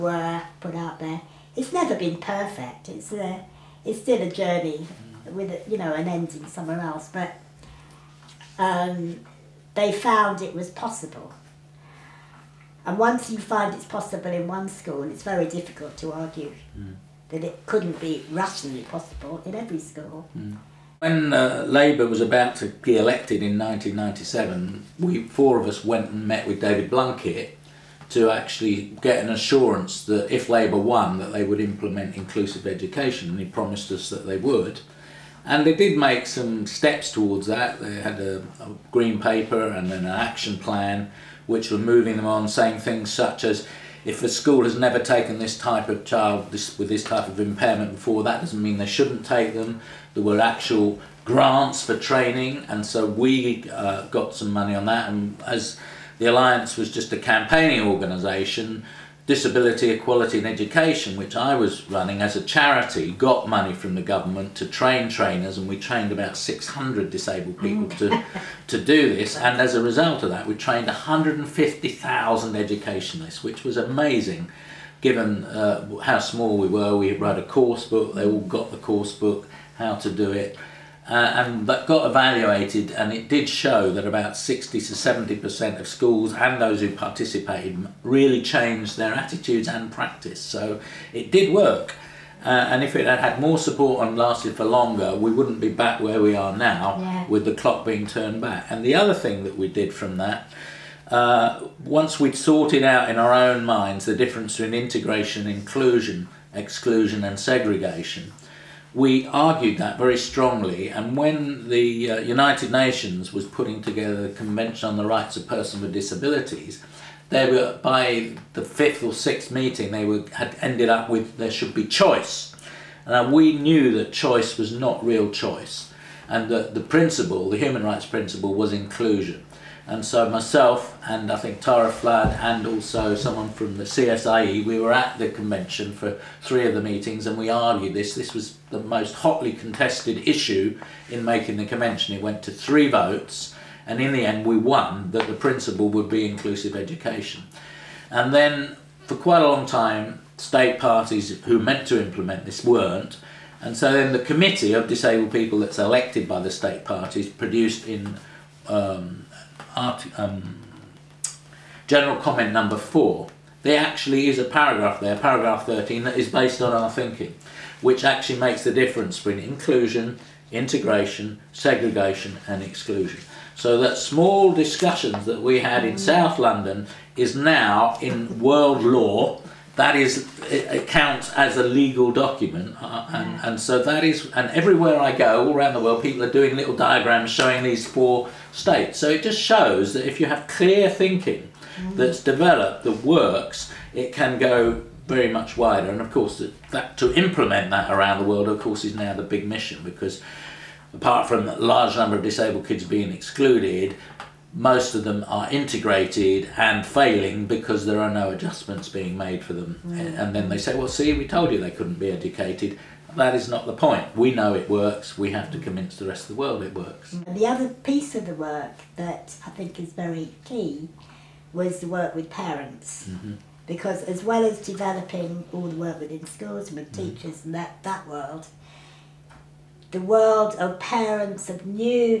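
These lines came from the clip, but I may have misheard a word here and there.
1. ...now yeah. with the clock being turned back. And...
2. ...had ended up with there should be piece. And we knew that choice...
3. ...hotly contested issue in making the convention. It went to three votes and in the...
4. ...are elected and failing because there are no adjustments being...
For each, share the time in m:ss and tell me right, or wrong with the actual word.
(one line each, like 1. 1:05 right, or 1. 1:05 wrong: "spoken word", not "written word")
1. 1:36 right
2. 2:00 wrong: "choice", not "piece"
3. 2:19 right
4. 3:25 wrong: "integrated", not "elected".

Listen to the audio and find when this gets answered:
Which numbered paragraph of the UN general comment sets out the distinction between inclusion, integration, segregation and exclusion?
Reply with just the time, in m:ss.
2:45.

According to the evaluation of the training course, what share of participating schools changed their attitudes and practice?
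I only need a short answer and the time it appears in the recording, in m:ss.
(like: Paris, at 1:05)
60 to 70%, at 1:24.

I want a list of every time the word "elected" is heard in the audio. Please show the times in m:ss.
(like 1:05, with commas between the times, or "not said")
0:22, 2:35.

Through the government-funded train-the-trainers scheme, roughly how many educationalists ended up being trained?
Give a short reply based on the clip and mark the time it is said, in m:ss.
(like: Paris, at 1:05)
150,000, at 1:10.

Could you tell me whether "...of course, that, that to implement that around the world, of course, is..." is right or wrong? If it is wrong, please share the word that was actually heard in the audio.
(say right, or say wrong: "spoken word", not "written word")
right.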